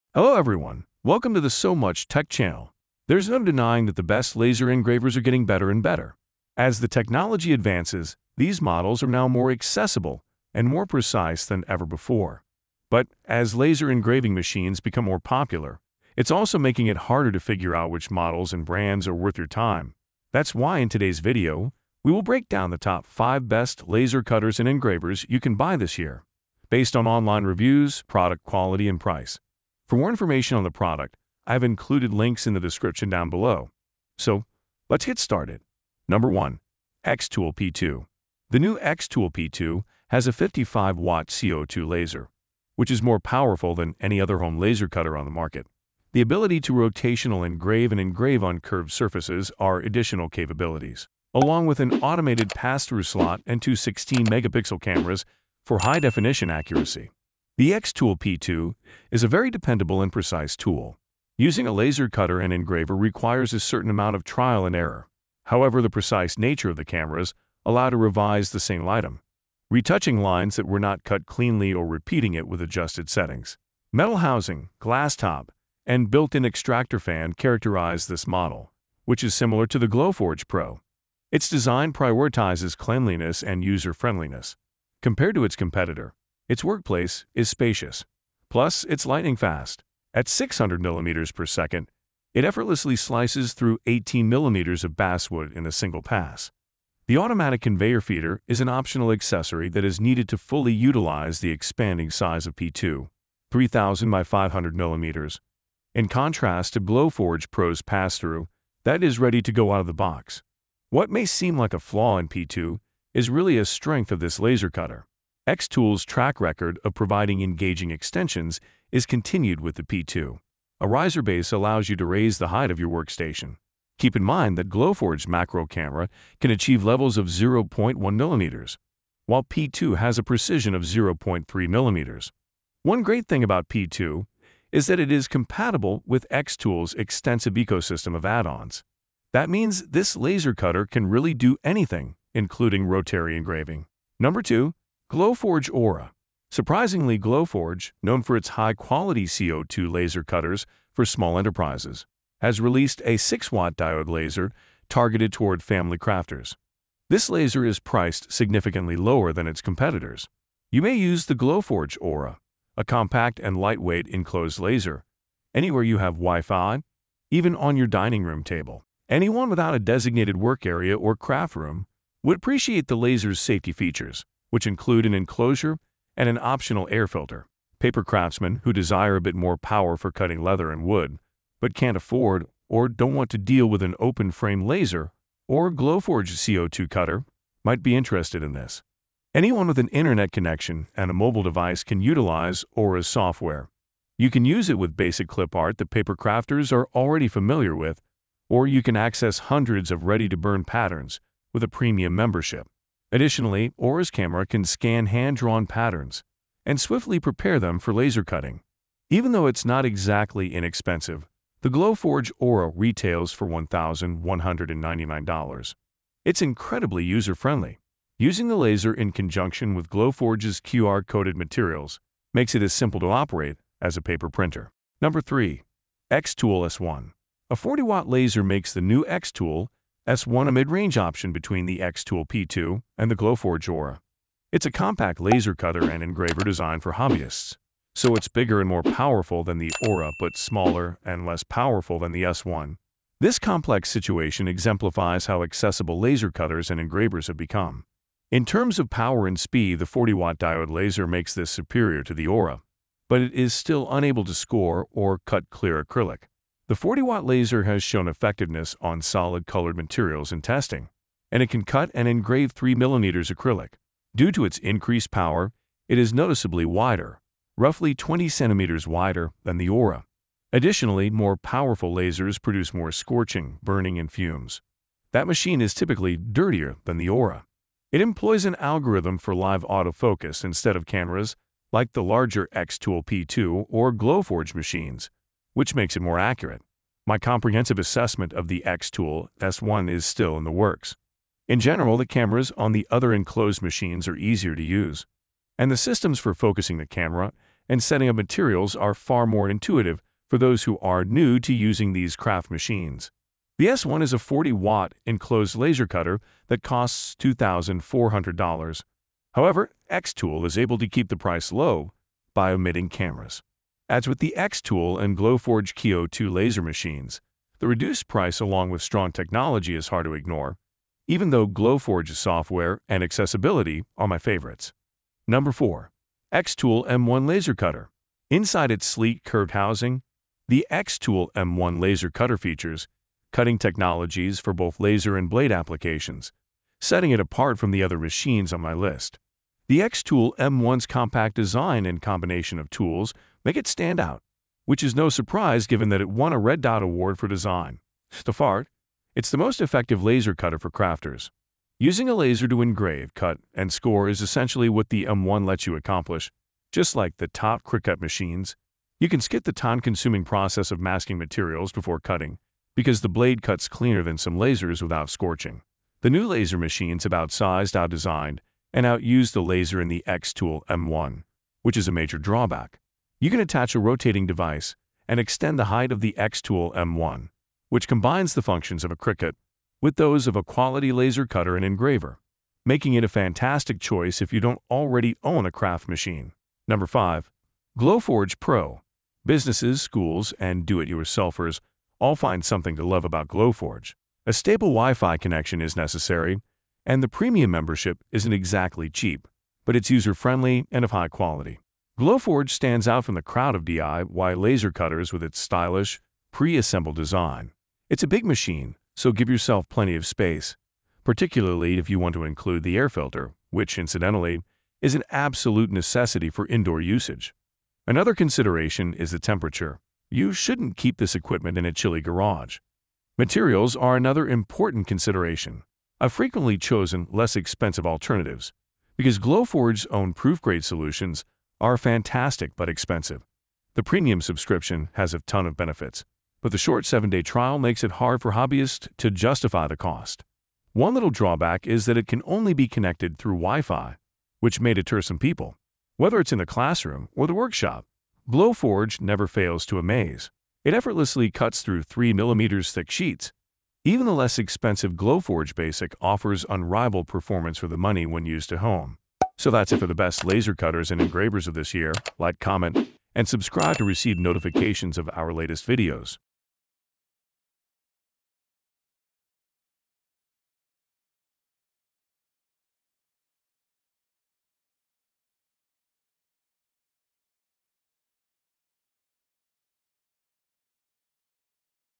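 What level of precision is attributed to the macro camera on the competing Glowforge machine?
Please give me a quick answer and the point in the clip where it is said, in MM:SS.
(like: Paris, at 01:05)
0.1 millimeters, at 02:07.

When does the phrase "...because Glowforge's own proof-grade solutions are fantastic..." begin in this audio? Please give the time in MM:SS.
07:08.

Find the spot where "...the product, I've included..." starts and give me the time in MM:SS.
00:30.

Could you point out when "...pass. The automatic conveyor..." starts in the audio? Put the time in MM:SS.
01:36.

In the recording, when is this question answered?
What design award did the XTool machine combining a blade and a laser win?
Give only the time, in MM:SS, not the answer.
05:46.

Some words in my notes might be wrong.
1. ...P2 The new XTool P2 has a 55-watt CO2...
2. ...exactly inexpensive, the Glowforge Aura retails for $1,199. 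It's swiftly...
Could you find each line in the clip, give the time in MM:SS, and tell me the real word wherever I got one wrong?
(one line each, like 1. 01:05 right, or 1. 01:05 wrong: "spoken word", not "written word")
1. 00:37 right
2. 03:29 wrong: "incredibly", not "swiftly".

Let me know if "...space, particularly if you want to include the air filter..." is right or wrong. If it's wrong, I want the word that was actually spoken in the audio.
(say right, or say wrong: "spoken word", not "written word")
right.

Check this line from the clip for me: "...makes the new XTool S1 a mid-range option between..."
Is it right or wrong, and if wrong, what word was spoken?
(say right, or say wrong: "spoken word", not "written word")
right.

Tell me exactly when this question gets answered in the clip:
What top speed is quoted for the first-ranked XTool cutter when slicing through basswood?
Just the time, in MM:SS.
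01:30.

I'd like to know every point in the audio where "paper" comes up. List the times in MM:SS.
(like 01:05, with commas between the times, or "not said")
02:57, 03:15, 03:44.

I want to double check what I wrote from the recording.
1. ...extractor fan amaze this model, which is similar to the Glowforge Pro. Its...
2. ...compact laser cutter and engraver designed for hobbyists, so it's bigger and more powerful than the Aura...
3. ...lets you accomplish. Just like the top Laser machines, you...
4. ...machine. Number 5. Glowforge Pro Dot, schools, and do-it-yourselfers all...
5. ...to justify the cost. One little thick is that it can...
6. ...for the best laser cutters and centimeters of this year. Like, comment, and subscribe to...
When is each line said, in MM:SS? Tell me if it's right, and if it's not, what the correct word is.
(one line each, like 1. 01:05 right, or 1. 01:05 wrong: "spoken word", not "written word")
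1. 01:16 wrong: "characterize", not "amaze"
2. 03:54 right
3. 05:55 wrong: "Cricut", not "Laser"
4. 06:25 wrong: "Businesses", not "Dot"
5. 07:18 wrong: "drawback", not "thick"
6. 07:39 wrong: "engravers", not "centimeters".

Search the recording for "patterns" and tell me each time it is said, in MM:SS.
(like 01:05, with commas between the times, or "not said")
03:20, 03:25.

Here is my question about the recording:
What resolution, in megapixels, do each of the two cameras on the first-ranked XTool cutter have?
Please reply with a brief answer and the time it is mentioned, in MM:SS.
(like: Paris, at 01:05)
16-megapixel, at 00:53.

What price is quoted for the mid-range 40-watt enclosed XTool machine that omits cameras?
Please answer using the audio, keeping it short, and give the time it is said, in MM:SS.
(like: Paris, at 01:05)
$2,400, at 05:07.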